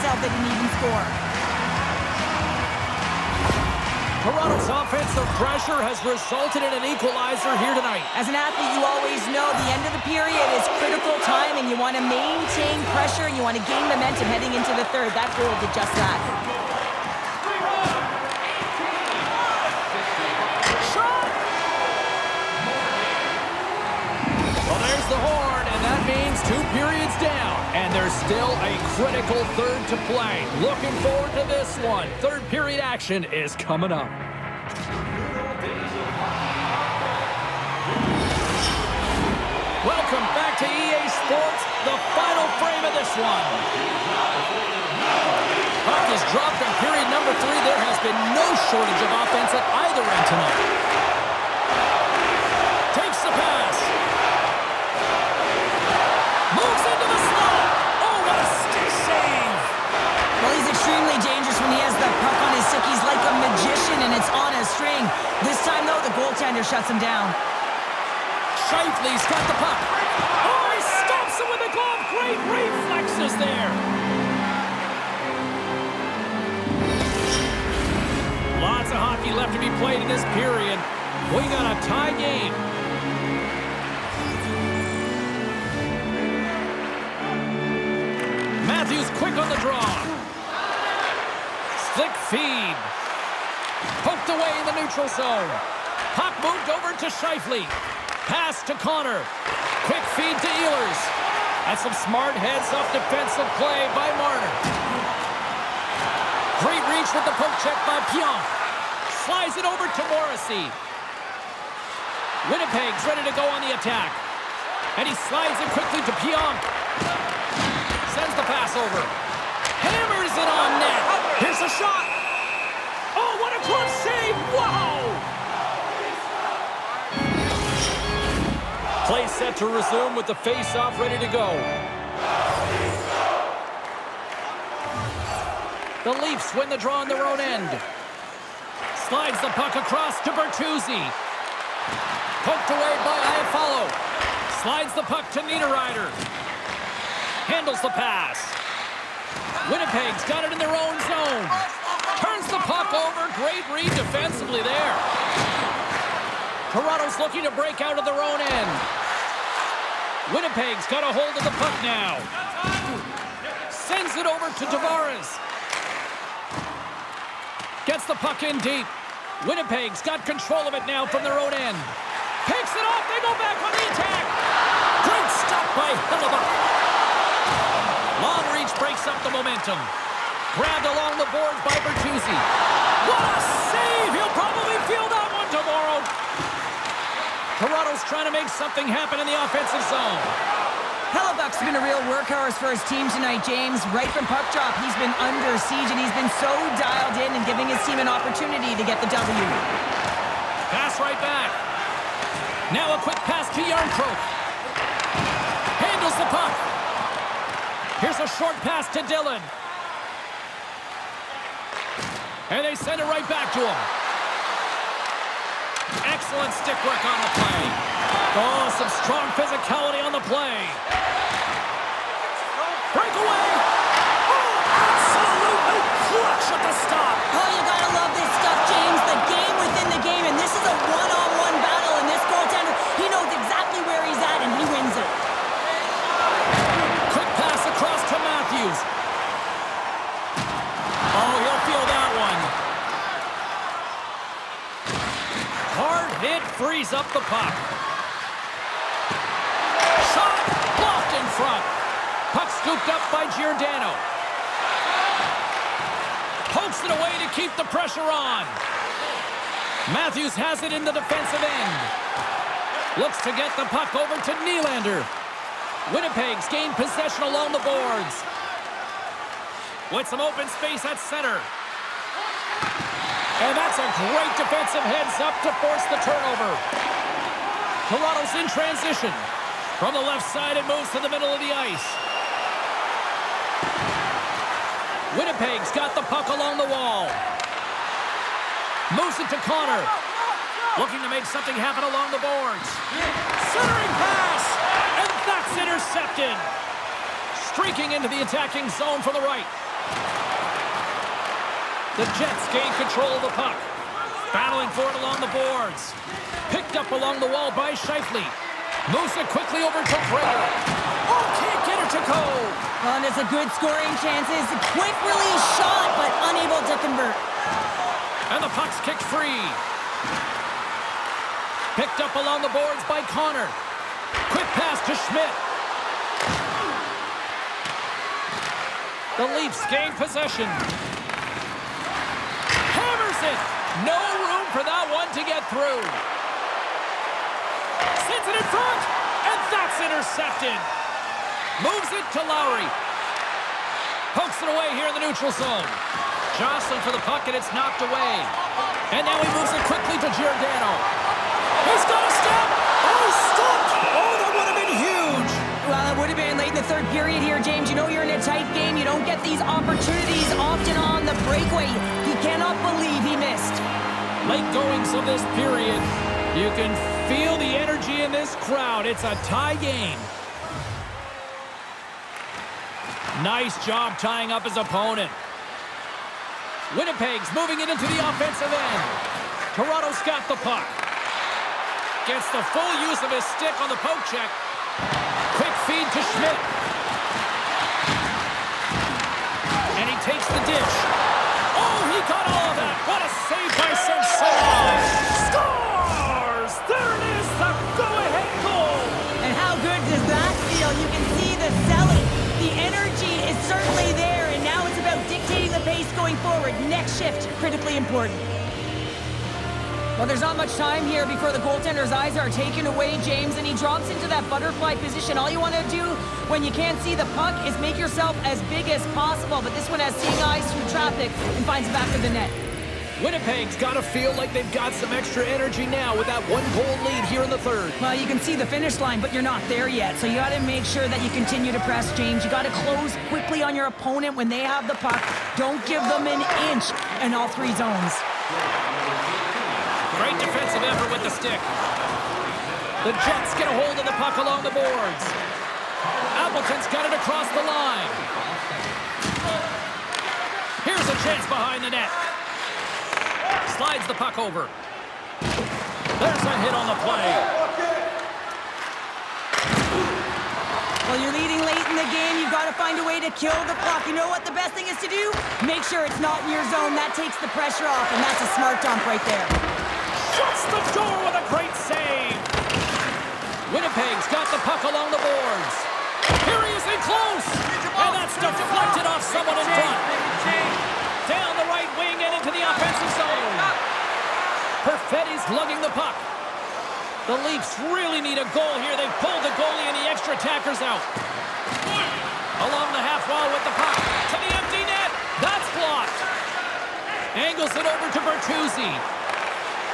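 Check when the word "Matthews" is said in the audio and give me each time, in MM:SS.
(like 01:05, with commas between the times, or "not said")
01:28, 04:19.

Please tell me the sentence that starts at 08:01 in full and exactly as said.
Down the right wing and into the offensive zone.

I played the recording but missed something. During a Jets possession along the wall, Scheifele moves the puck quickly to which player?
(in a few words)
Frater.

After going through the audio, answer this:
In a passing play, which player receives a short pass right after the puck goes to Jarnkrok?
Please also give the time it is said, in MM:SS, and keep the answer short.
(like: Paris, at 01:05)
Dillon, at 03:28.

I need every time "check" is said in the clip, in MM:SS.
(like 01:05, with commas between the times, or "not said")
01:47, 06:24.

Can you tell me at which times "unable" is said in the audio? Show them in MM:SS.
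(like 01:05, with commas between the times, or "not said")
05:16.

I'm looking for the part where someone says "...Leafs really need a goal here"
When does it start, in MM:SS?
08:07.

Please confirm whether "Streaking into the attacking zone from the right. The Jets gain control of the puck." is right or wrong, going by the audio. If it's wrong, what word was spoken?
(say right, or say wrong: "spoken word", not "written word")
right.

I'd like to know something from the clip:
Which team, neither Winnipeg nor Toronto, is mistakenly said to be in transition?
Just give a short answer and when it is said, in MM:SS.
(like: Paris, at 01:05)
Colorado, at 04:37.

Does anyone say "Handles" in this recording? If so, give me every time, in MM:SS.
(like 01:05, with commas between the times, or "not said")
02:27, 03:25.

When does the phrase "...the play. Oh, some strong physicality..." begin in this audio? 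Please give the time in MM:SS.
03:37.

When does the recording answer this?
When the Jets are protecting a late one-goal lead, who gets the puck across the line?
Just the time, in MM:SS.
07:26.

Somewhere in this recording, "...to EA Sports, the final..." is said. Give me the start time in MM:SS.
00:40.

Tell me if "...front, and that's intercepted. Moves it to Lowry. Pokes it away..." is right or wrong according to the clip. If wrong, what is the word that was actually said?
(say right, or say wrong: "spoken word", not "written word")
right.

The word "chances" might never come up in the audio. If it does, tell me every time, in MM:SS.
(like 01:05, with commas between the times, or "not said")
05:14, 07:31.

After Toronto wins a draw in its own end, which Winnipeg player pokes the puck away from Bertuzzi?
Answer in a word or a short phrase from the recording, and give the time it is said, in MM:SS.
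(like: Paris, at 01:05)
Iafallo, at 02:22.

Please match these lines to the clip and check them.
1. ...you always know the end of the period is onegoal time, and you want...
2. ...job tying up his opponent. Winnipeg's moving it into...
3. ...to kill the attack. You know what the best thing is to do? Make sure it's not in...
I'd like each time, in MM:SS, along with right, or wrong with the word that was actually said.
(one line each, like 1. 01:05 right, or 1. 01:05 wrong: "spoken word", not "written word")
1. 00:08 wrong: "critical", not "onegoal"
2. 06:13 right
3. 07:42 wrong: "clock", not "attack".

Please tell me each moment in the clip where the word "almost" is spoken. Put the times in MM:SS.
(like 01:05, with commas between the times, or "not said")
not said.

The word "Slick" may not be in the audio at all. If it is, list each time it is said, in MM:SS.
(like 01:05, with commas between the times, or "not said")
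01:31.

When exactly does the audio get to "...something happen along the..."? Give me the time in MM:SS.
04:51.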